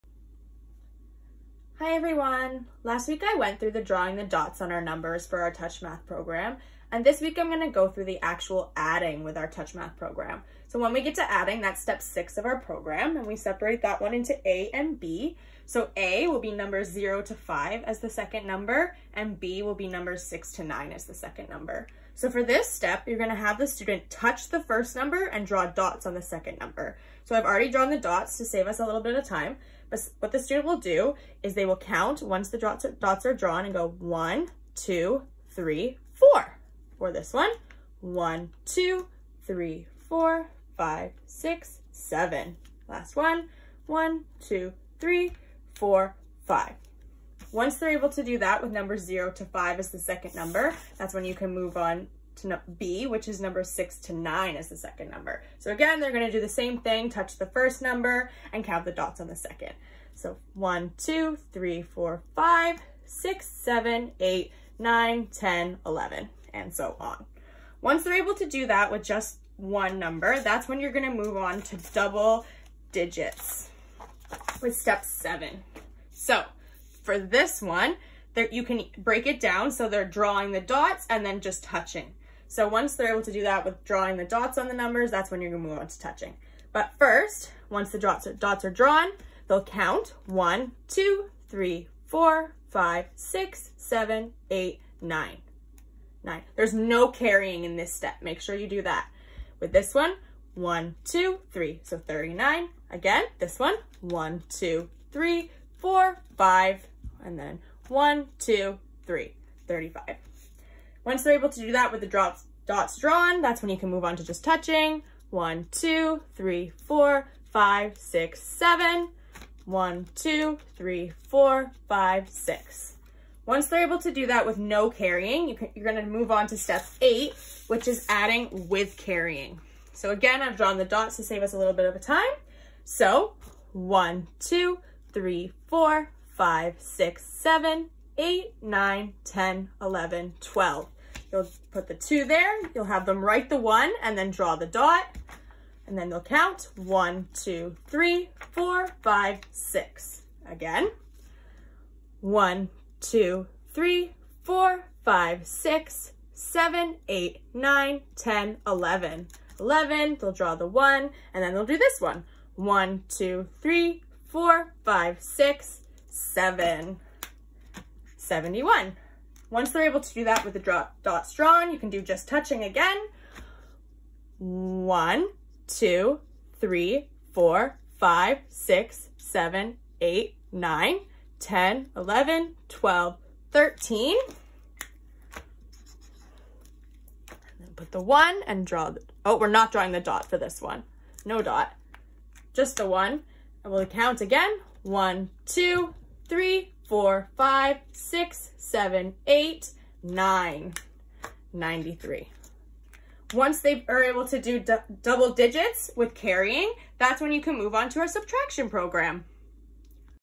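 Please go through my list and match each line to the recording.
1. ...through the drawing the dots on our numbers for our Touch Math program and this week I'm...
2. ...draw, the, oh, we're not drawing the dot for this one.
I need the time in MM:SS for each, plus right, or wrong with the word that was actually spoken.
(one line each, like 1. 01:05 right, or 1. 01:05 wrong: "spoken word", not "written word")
1. 00:03 right
2. 03:08 right.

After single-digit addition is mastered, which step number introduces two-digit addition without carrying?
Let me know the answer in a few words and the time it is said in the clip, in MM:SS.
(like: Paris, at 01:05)
Step 7, at 01:14.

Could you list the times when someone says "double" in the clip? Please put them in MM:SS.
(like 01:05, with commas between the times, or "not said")
01:11, 03:25.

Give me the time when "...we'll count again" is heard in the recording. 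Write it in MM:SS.
03:13.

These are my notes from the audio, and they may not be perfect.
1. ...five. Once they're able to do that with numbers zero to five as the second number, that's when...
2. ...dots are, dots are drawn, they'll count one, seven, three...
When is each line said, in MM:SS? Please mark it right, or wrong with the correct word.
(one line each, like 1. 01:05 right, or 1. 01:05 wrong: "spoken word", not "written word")
1. 00:46 right
2. 01:27 wrong: "two", not "seven".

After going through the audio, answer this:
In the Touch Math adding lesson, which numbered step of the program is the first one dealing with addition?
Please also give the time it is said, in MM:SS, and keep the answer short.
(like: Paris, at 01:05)
Step 6, at 00:11.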